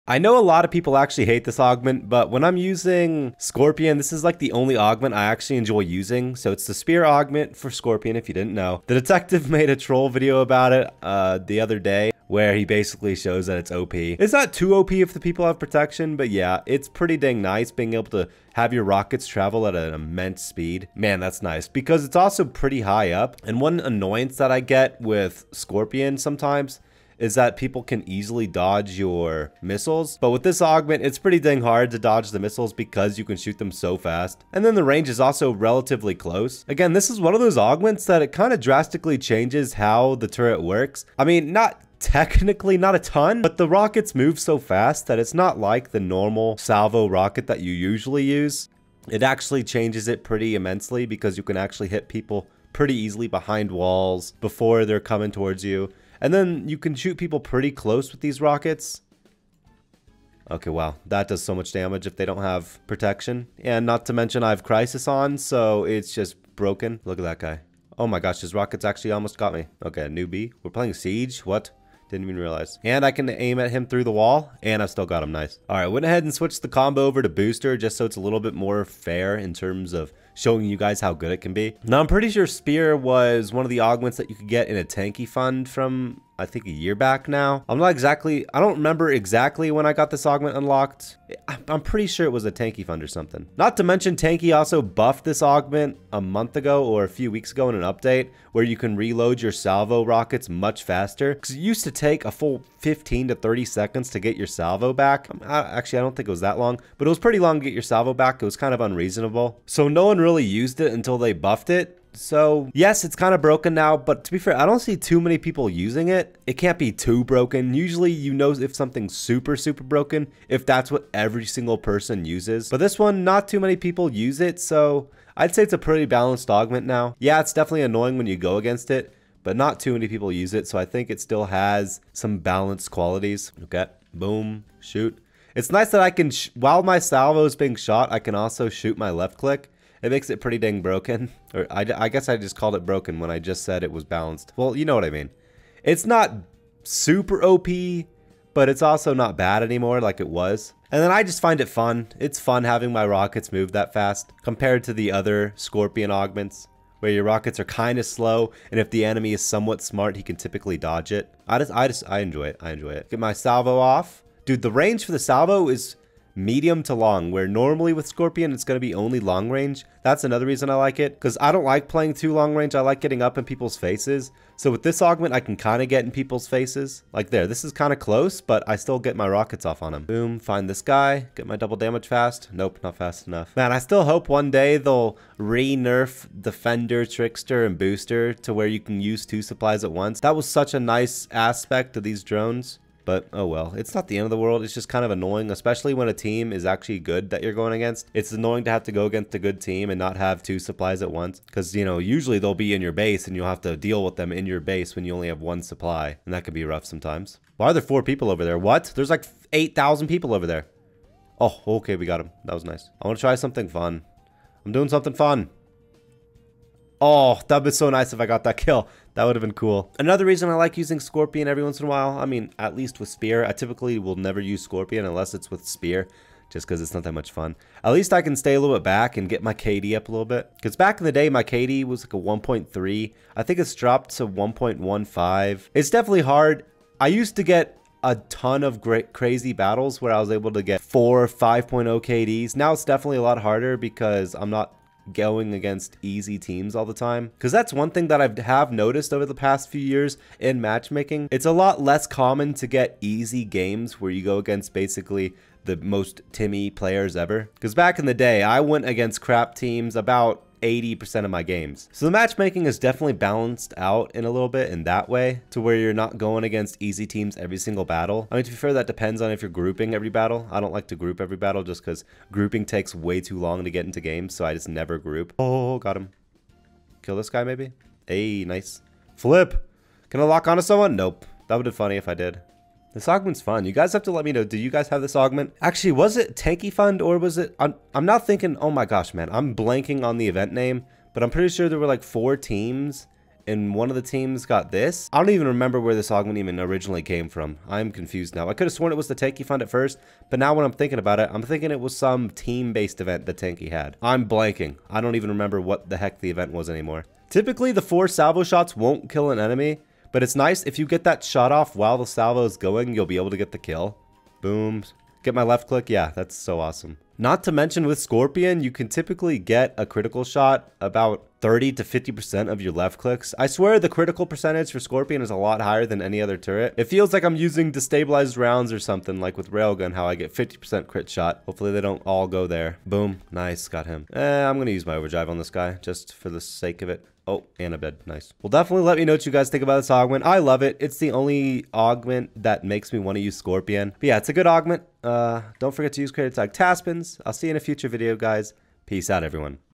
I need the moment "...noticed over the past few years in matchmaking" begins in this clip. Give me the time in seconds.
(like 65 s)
248 s.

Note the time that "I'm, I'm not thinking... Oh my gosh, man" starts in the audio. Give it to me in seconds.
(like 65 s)
287 s.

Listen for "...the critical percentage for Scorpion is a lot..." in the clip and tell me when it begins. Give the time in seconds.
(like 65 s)
323 s.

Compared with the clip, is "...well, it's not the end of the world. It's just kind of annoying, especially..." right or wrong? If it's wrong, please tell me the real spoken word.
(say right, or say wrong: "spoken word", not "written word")
right.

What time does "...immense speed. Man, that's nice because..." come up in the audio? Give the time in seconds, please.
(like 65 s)
19 s.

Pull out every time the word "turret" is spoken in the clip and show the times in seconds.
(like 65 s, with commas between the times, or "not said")
40 s, 326 s.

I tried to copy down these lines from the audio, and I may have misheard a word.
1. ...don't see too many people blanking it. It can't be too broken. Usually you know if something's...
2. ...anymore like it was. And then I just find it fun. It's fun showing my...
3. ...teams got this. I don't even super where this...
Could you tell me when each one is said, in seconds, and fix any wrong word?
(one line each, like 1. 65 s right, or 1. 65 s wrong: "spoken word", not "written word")
1. 114 s wrong: "using", not "blanking"
2. 149 s wrong: "having", not "showing"
3. 294 s wrong: "remember", not "super".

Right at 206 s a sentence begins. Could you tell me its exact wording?
And that can be rough sometimes.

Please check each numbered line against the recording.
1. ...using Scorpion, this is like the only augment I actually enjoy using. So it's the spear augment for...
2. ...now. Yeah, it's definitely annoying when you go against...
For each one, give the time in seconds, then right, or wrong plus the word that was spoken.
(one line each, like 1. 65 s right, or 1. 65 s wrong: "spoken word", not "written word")
1. 2 s right
2. 126 s right.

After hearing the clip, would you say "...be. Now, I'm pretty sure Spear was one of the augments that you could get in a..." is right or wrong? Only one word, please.
right.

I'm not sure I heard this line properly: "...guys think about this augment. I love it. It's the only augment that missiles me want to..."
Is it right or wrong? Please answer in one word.
wrong.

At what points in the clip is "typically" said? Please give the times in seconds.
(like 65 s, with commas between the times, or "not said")
160 s, 223 s, 307 s, 318 s.